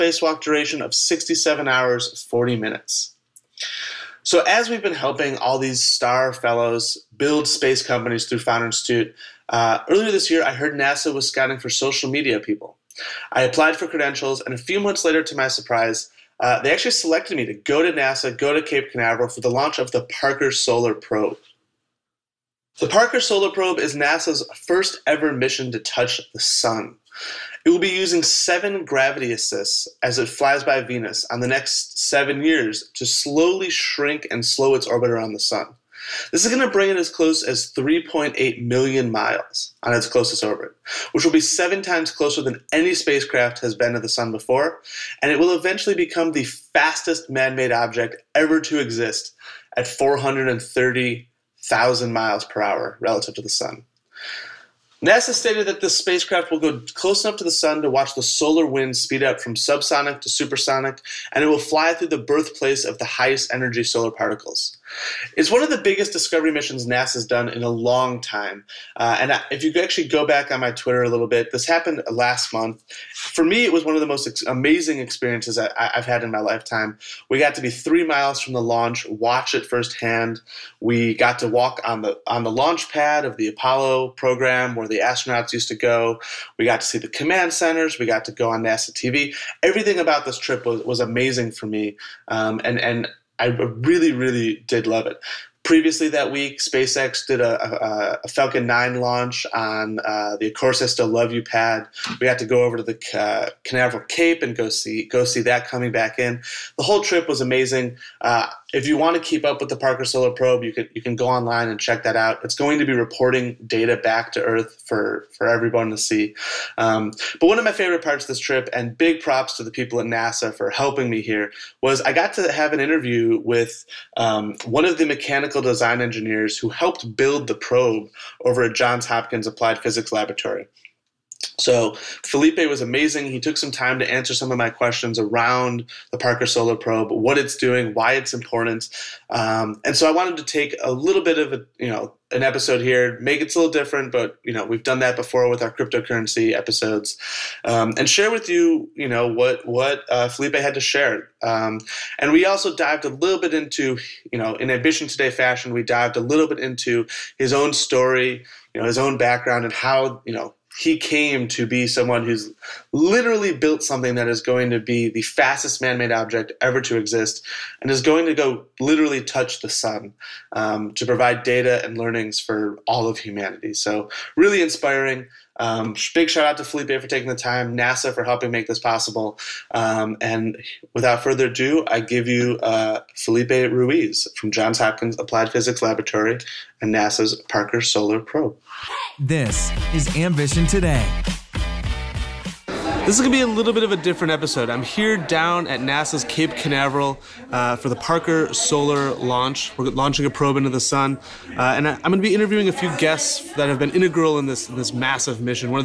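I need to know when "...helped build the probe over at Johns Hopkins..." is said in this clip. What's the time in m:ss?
2:06.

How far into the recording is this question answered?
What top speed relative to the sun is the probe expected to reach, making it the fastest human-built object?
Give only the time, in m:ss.
0:49.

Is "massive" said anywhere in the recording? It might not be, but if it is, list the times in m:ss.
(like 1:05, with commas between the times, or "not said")
3:24.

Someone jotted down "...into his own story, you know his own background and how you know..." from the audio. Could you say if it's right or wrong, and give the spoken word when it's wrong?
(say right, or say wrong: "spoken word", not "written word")
right.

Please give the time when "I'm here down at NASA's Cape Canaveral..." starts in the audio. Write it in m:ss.
3:14.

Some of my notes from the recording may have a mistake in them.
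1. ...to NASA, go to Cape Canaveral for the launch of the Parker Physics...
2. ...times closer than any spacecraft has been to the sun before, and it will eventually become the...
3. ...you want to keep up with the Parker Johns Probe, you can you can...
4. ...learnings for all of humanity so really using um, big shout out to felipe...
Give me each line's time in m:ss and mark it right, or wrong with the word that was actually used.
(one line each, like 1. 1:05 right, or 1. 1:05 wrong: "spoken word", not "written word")
1. 0:17 wrong: "Solar", not "Physics"
2. 0:41 right
3. 1:48 wrong: "Solar", not "Johns"
4. 2:51 wrong: "inspiring", not "using".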